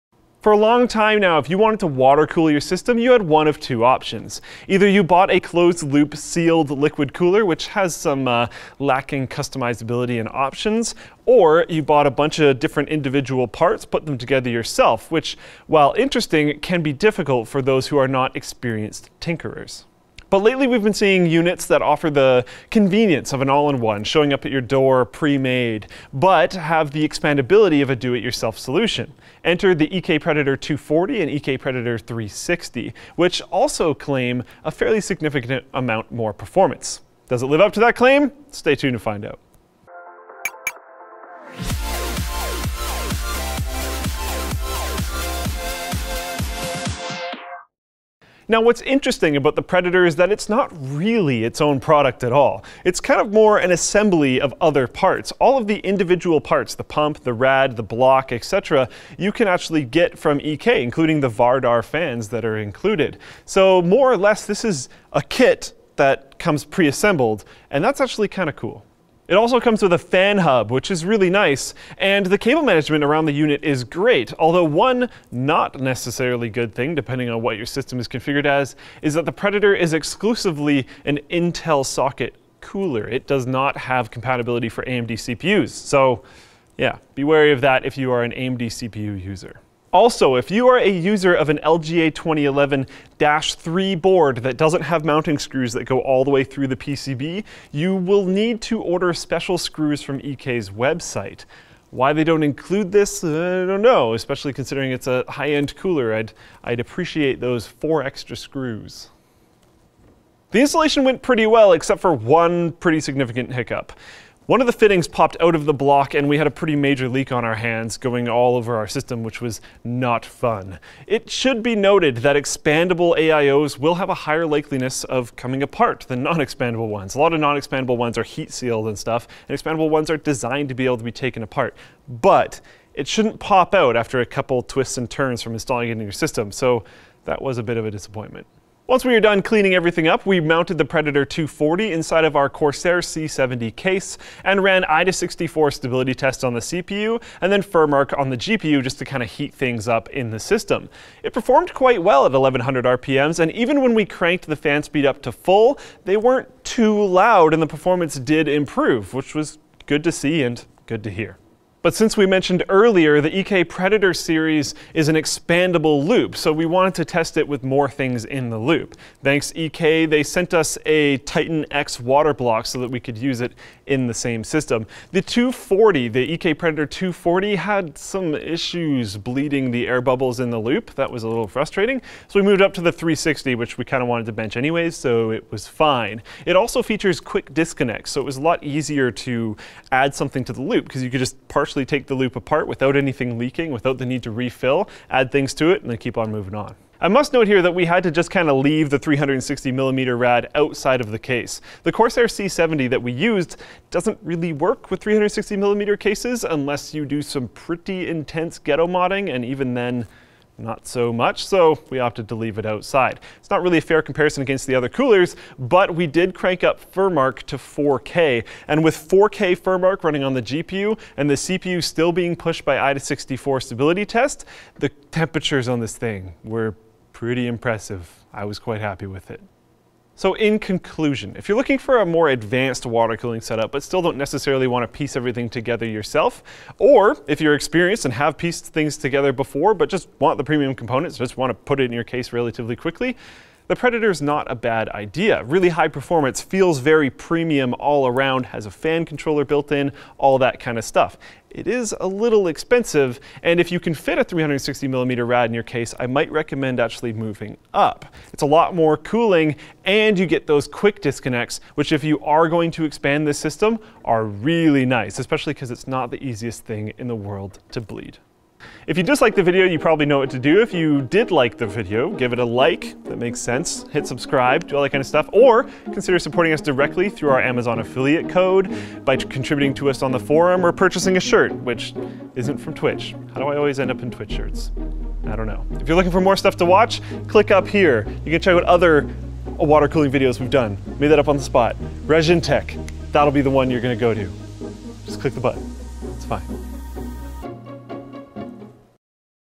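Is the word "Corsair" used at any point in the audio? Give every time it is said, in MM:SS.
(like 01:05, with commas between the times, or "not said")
02:22, 03:21.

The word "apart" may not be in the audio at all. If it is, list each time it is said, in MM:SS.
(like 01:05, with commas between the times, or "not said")
02:05, 02:11, 03:12.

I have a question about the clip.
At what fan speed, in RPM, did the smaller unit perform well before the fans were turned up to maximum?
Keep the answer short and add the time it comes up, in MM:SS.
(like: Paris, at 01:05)
1100, at 02:32.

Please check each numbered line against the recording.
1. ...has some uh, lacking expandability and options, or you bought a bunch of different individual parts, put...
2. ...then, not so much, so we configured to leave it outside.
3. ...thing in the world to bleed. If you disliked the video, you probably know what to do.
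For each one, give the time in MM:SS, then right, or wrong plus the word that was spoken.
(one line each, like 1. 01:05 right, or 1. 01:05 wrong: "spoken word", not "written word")
1. 00:07 wrong: "customizability", not "expandability"
2. 03:29 wrong: "opted", not "configured"
3. 04:26 right.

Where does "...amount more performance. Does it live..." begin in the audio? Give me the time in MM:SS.
00:35.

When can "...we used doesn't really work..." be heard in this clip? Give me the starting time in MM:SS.
03:23.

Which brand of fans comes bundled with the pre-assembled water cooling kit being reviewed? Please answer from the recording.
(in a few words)
Vardar.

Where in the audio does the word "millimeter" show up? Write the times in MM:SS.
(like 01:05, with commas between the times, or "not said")
03:19, 03:25.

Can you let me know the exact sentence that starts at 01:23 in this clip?
It does not have compatibility for AMD CPUs, so yeah, be wary of that if you are an AMD CPU user.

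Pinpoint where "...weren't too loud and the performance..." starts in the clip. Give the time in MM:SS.
02:36.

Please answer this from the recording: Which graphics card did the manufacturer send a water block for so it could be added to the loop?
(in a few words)
Titan X.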